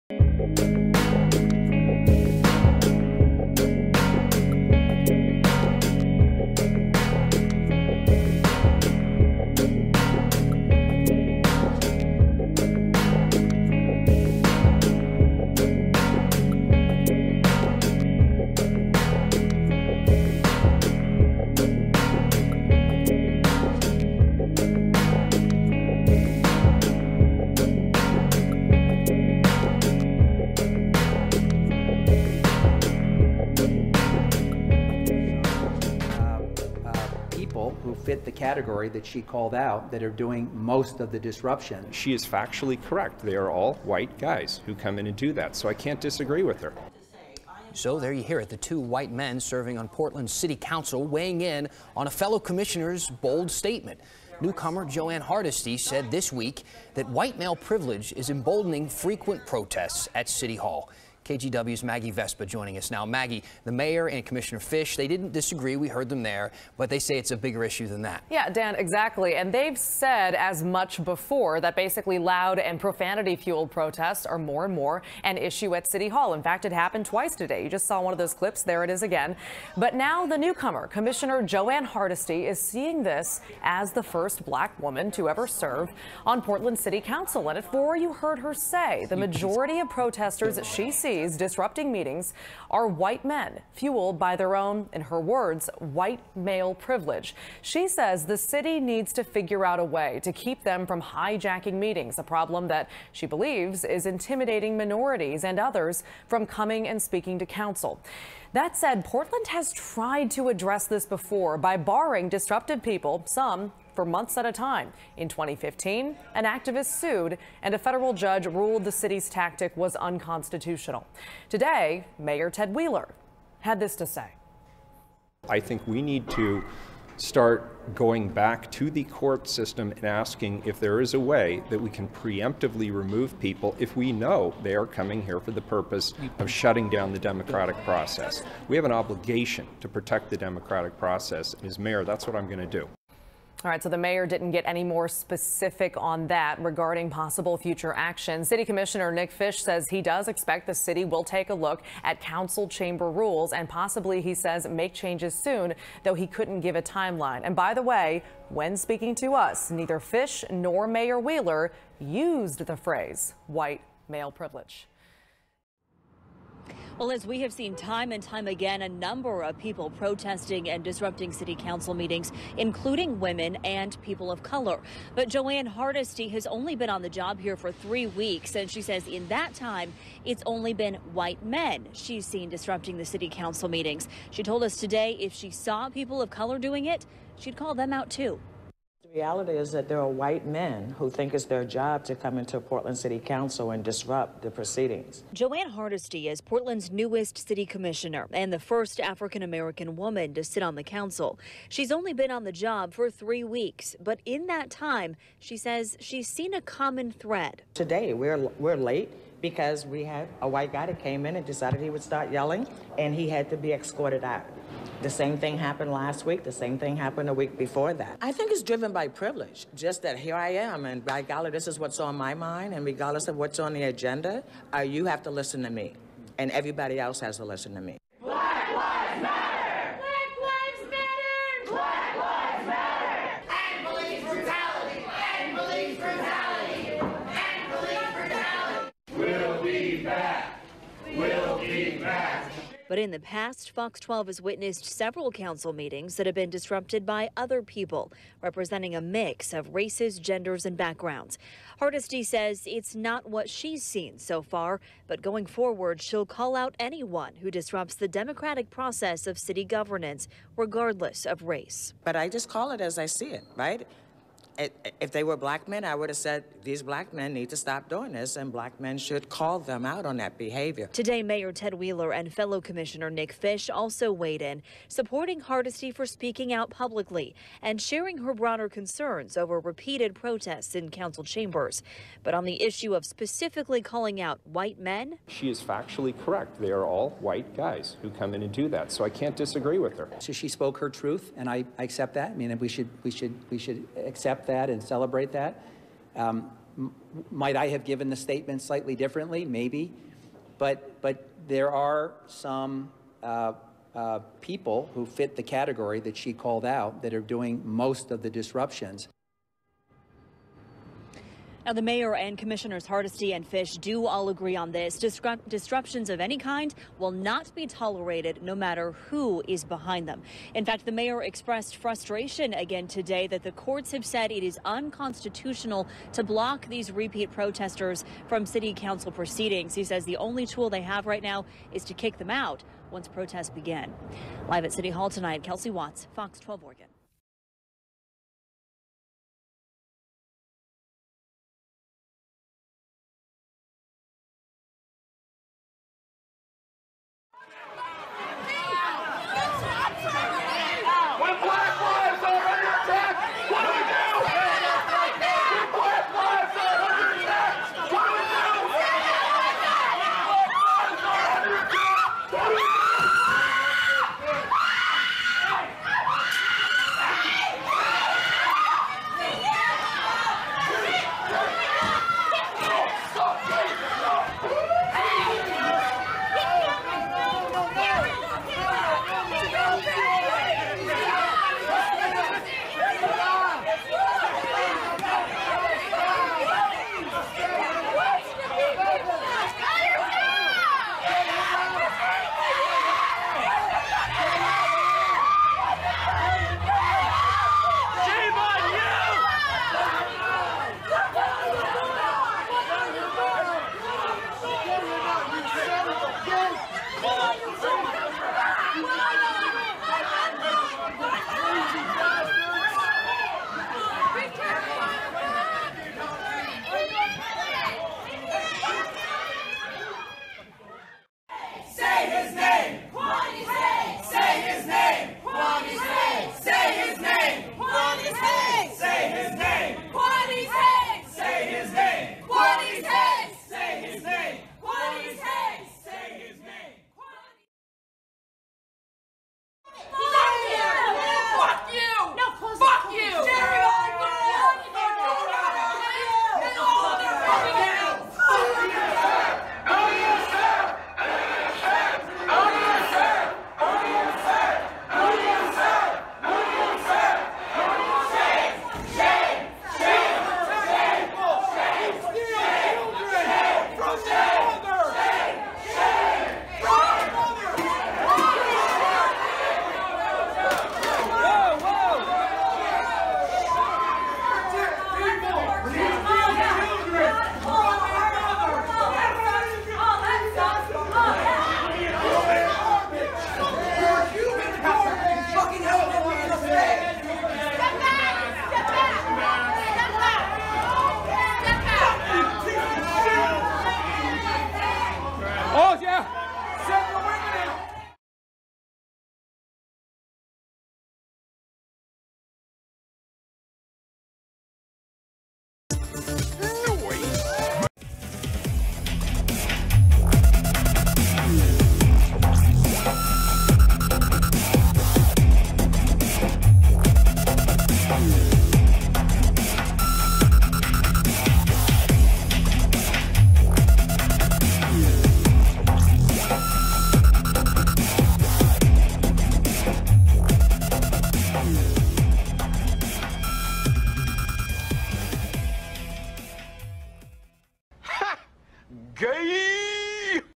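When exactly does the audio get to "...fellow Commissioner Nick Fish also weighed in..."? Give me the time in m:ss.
4:32.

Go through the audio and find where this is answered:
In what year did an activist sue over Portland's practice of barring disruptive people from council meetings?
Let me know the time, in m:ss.
1:55.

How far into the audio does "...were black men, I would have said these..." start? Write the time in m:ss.
4:25.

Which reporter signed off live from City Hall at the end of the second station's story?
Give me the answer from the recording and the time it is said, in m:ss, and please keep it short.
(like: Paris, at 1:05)
Kelsey Watts, at 5:35.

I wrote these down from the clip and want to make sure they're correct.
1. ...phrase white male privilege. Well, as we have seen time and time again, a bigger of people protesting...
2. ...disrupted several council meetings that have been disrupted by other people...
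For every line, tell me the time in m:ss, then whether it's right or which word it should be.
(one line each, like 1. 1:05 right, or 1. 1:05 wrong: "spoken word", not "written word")
1. 2:42 wrong: "number", not "bigger"
2. 4:04 wrong: "witnessed", not "disrupted".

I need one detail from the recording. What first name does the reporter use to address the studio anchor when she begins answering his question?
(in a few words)
Dan.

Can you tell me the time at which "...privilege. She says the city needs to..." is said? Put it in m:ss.
1:36.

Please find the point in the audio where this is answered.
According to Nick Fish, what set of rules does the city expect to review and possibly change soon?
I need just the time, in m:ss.
2:32.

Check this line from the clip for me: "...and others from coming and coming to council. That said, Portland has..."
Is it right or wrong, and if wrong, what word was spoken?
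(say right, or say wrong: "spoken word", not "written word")
wrong: "speaking", not "coming".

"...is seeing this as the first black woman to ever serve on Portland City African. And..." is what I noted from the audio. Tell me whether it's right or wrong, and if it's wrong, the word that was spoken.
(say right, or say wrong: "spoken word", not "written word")
wrong: "Council", not "African".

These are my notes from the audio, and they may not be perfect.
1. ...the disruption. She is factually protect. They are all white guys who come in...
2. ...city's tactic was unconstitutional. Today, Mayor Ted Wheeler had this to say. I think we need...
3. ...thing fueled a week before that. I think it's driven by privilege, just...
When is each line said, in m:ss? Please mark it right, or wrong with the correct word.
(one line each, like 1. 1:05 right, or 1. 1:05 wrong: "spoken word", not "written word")
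1. 0:41 wrong: "correct", not "protect"
2. 1:58 right
3. 3:36 wrong: "happened", not "fueled".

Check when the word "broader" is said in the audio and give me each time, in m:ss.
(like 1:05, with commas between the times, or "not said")
4:38.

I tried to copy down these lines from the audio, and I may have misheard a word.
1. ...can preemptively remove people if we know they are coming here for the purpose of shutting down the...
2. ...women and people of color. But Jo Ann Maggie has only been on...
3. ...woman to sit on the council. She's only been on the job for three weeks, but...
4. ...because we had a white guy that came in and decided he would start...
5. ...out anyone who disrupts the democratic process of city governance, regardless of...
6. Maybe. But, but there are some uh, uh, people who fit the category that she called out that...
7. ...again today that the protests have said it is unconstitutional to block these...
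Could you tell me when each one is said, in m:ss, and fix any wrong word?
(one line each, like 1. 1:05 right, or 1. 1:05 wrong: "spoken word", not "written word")
1. 2:11 right
2. 2:53 wrong: "Hardesty", not "Maggie"
3. 3:19 right
4. 3:29 right
5. 4:16 right
6. 4:59 right
7. 5:22 wrong: "courts", not "protests".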